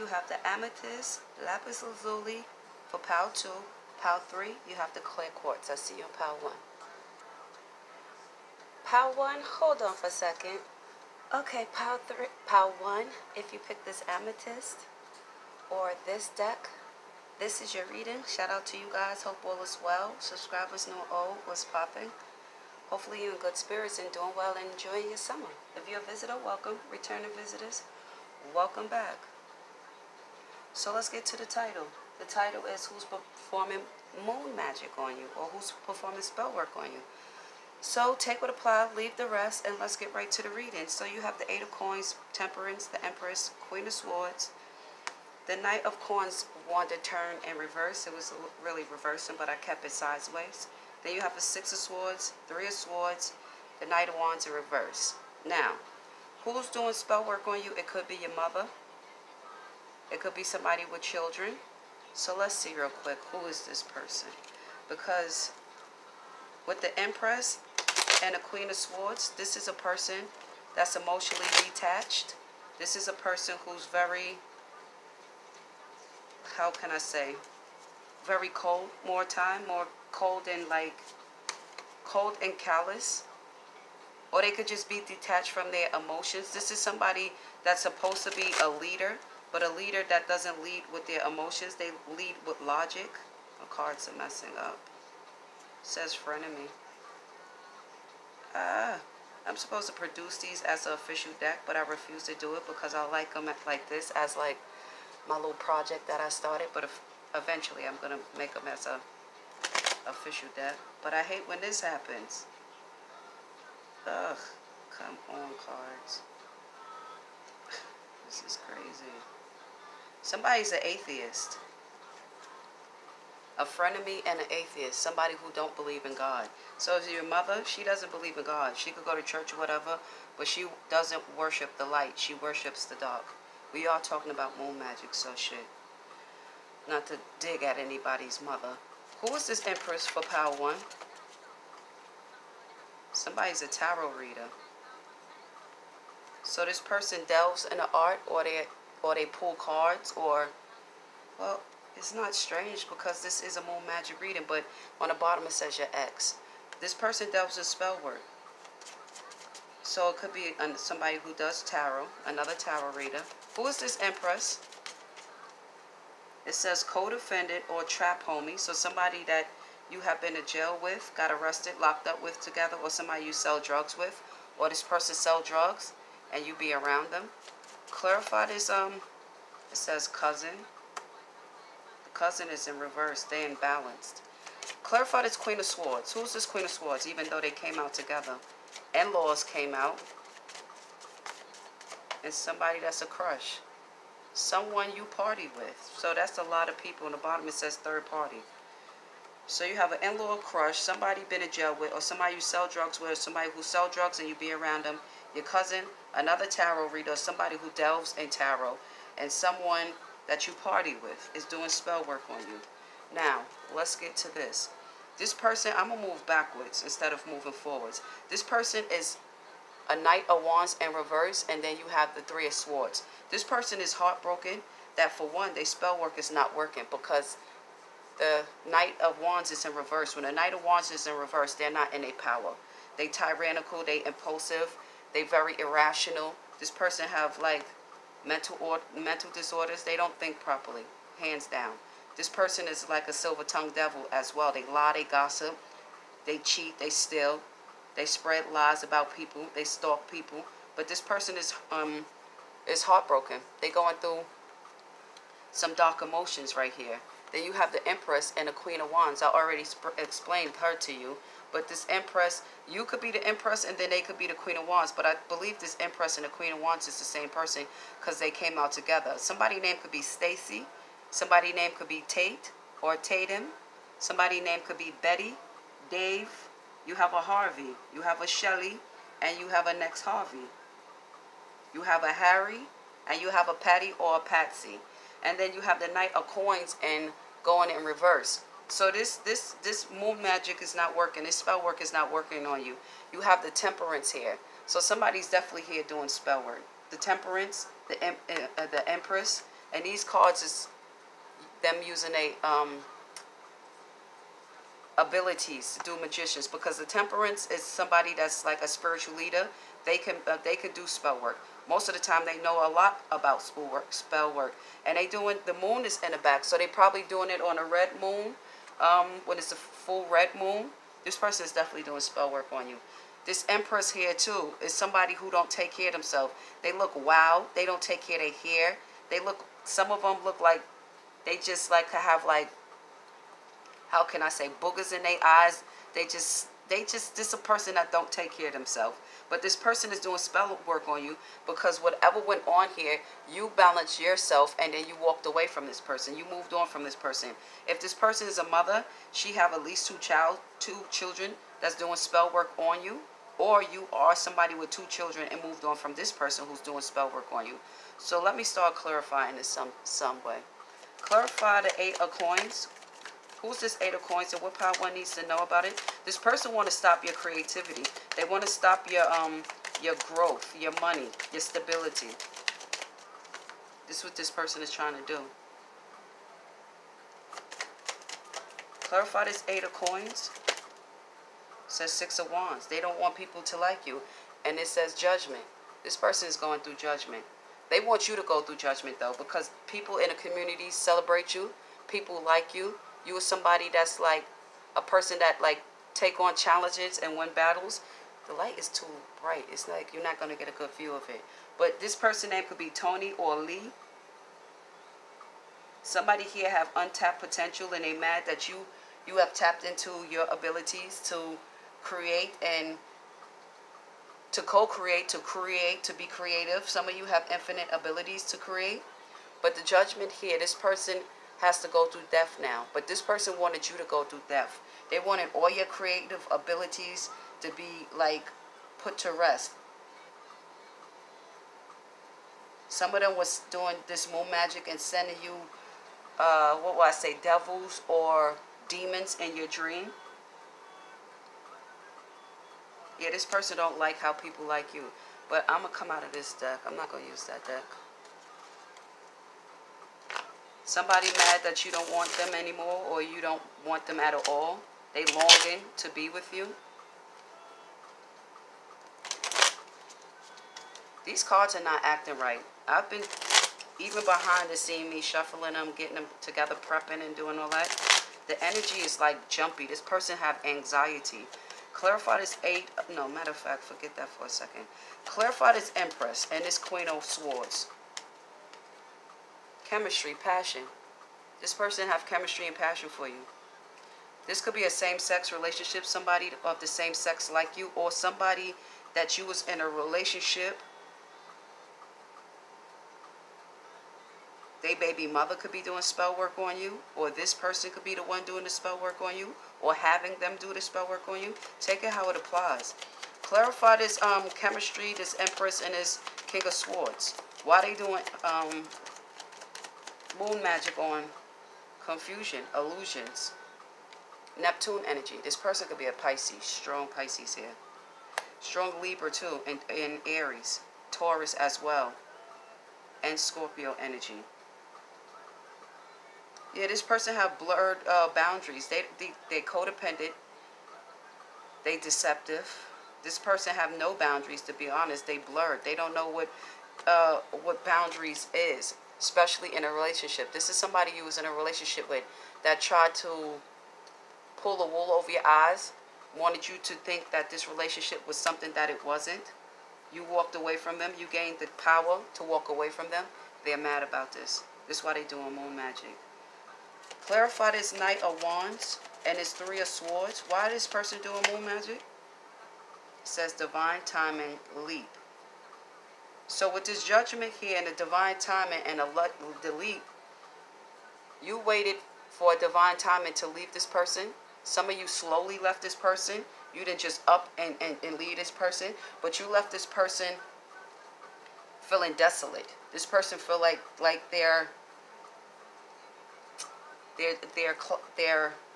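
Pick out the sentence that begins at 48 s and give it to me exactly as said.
It was really reversing, but I kept it sideways.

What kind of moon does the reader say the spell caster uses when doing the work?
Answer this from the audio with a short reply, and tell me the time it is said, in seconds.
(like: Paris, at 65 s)
Full red moon, at 319 s.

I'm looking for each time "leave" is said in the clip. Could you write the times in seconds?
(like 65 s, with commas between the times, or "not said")
38 s, 573 s, 577 s.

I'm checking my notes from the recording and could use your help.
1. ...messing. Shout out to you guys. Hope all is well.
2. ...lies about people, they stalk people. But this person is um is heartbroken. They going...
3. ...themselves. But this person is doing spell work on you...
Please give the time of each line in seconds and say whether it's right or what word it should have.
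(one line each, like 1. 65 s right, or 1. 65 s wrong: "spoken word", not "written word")
1. 17 s wrong: "reading", not "messing"
2. 248 s right
3. 338 s right.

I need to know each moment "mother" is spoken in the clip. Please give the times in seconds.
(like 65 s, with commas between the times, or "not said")
58 s, 127 s, 138 s, 348 s, 495 s.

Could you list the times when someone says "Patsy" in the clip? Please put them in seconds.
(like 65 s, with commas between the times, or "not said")
284 s.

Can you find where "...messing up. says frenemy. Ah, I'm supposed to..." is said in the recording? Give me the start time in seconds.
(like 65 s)
94 s.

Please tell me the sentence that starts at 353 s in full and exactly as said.
Or you are somebody with two children and moved on from this person who's doing spell work on you.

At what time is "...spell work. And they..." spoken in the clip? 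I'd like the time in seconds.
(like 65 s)
313 s.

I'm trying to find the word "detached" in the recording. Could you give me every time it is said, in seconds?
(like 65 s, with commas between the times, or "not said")
71 s, 85 s.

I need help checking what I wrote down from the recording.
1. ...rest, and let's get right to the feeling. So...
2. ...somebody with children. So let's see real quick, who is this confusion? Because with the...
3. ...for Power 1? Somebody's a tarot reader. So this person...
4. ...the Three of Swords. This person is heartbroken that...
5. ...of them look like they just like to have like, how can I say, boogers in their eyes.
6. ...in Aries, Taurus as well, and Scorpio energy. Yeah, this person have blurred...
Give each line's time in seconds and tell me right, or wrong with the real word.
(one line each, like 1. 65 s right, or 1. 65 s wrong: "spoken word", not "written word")
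1. 39 s wrong: "reading", not "feeling"
2. 60 s wrong: "person", not "confusion"
3. 140 s right
4. 222 s right
5. 329 s right
6. 519 s right.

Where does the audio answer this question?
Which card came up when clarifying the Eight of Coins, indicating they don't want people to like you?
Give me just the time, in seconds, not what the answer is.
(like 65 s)
381 s.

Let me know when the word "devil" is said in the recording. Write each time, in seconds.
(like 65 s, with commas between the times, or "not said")
243 s, 437 s.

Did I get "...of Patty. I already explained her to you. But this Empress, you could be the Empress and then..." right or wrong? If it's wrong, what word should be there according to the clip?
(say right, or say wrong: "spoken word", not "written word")
wrong: "Wands", not "Patty".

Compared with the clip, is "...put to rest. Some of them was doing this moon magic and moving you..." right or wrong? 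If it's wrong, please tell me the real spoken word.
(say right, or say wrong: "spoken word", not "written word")
wrong: "sending", not "moving".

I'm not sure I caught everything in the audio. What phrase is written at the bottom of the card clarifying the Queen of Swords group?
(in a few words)
Third party.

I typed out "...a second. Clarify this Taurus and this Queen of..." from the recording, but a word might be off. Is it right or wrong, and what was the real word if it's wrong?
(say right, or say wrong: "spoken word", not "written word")
wrong: "Empress", not "Taurus".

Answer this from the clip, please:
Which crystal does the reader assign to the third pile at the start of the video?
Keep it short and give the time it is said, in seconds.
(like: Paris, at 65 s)
Clear quartz, at 5 s.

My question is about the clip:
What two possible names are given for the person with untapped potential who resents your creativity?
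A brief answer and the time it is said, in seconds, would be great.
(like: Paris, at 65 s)
Tony or Lee, at 402 s.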